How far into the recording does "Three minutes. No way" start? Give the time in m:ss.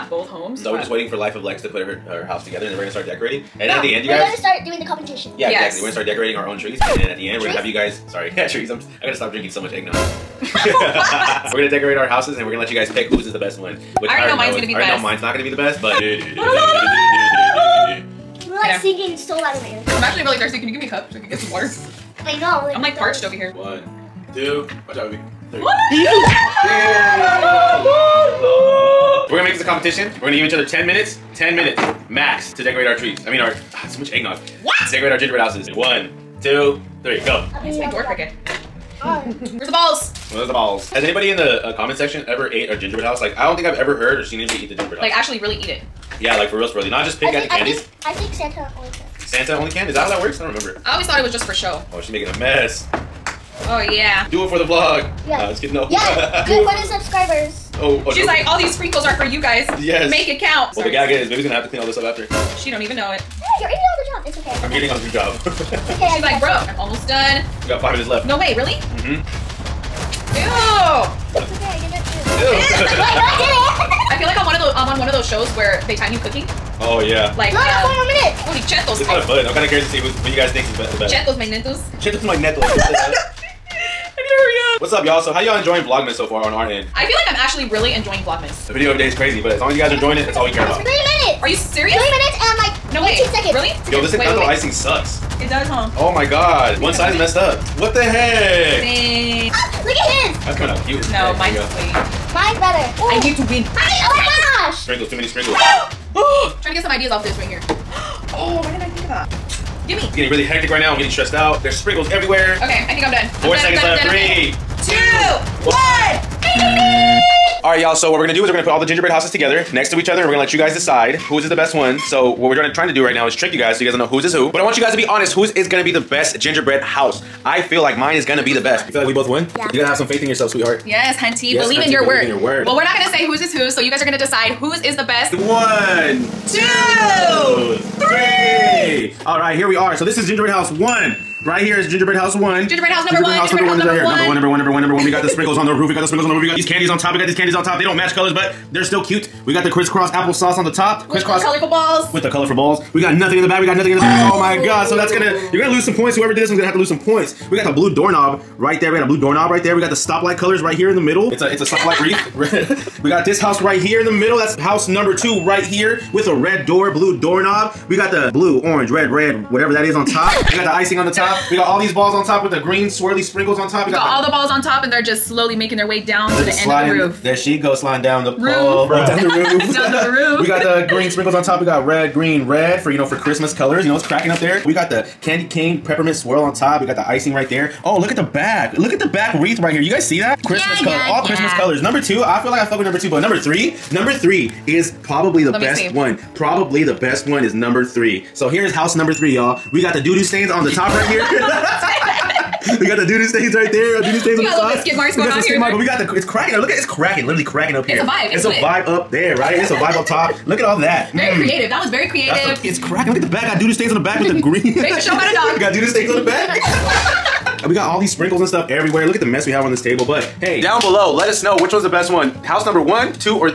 1:31.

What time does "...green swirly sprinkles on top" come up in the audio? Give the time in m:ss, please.
2:52.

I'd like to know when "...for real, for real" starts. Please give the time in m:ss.
0:46.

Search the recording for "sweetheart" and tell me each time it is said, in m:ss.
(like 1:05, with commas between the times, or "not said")
2:10.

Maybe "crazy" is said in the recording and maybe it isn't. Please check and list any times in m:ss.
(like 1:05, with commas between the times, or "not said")
1:29.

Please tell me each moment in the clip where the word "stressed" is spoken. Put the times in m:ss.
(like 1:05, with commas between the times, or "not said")
1:51.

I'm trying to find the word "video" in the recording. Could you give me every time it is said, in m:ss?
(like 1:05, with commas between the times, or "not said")
1:28.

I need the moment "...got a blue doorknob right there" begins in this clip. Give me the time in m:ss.
2:38.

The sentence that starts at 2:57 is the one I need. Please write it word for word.
There she goes sliding down the roof.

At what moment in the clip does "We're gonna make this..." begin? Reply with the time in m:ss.
0:29.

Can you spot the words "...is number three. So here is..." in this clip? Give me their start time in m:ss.
3:17.